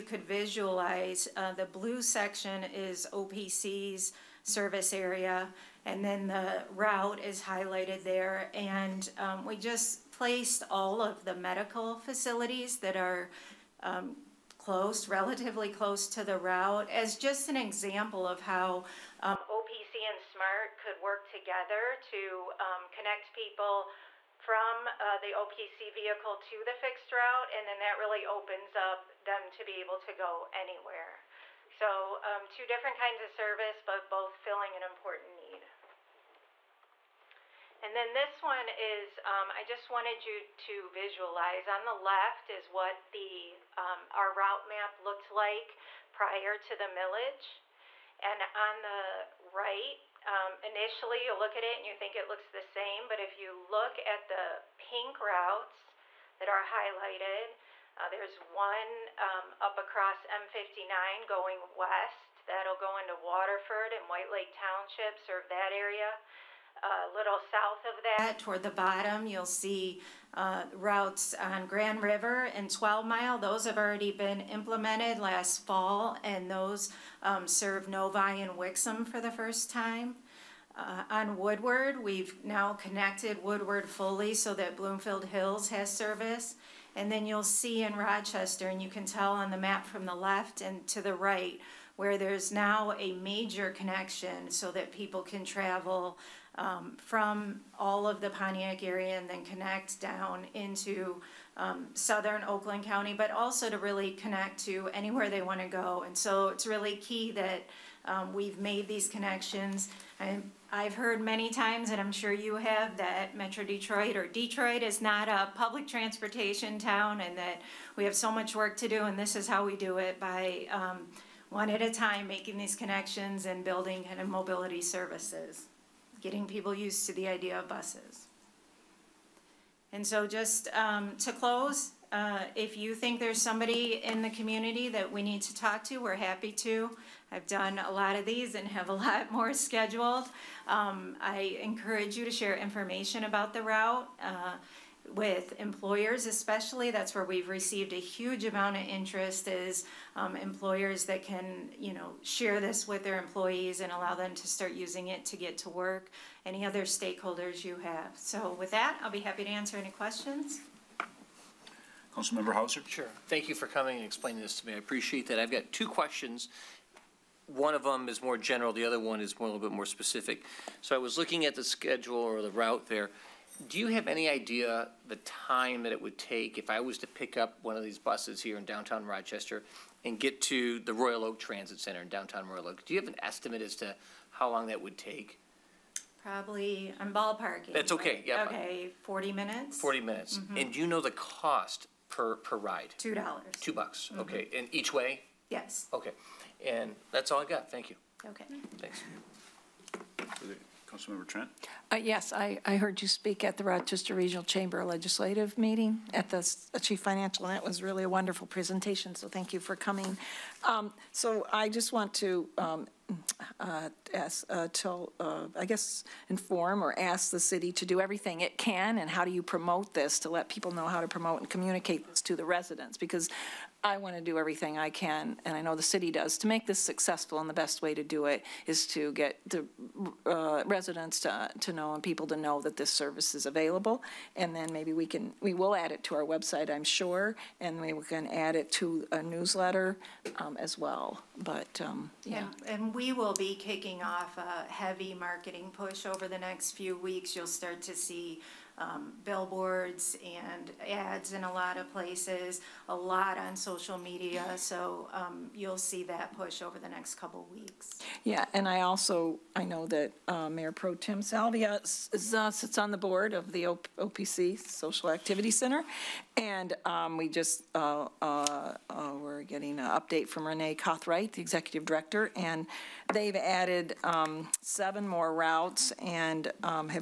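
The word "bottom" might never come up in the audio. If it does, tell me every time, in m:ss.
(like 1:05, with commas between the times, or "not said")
1:08.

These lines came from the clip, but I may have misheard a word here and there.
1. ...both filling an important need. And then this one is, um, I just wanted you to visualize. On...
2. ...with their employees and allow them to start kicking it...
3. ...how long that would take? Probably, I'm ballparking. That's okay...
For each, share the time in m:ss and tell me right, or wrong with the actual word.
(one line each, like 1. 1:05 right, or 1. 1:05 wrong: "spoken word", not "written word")
1. 0:34 right
2. 2:32 wrong: "using", not "kicking"
3. 3:04 right.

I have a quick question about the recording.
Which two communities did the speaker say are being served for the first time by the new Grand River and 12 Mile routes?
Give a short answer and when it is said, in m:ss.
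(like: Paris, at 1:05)
Novi and Wixom, at 1:17.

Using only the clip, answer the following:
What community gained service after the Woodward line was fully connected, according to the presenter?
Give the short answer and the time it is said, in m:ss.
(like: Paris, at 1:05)
Bloomfield Hills, at 1:24.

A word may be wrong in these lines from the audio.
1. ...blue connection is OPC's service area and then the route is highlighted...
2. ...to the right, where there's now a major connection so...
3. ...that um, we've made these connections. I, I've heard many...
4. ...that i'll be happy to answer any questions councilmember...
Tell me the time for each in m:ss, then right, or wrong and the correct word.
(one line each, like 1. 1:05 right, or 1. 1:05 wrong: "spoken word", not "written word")
1. 0:01 wrong: "section", not "connection"
2. 1:30 right
3. 1:47 right
4. 2:38 right.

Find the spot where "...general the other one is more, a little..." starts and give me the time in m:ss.
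2:48.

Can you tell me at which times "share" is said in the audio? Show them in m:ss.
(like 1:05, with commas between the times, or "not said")
2:22, 2:32.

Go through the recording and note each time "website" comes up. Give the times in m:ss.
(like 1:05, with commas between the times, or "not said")
3:56.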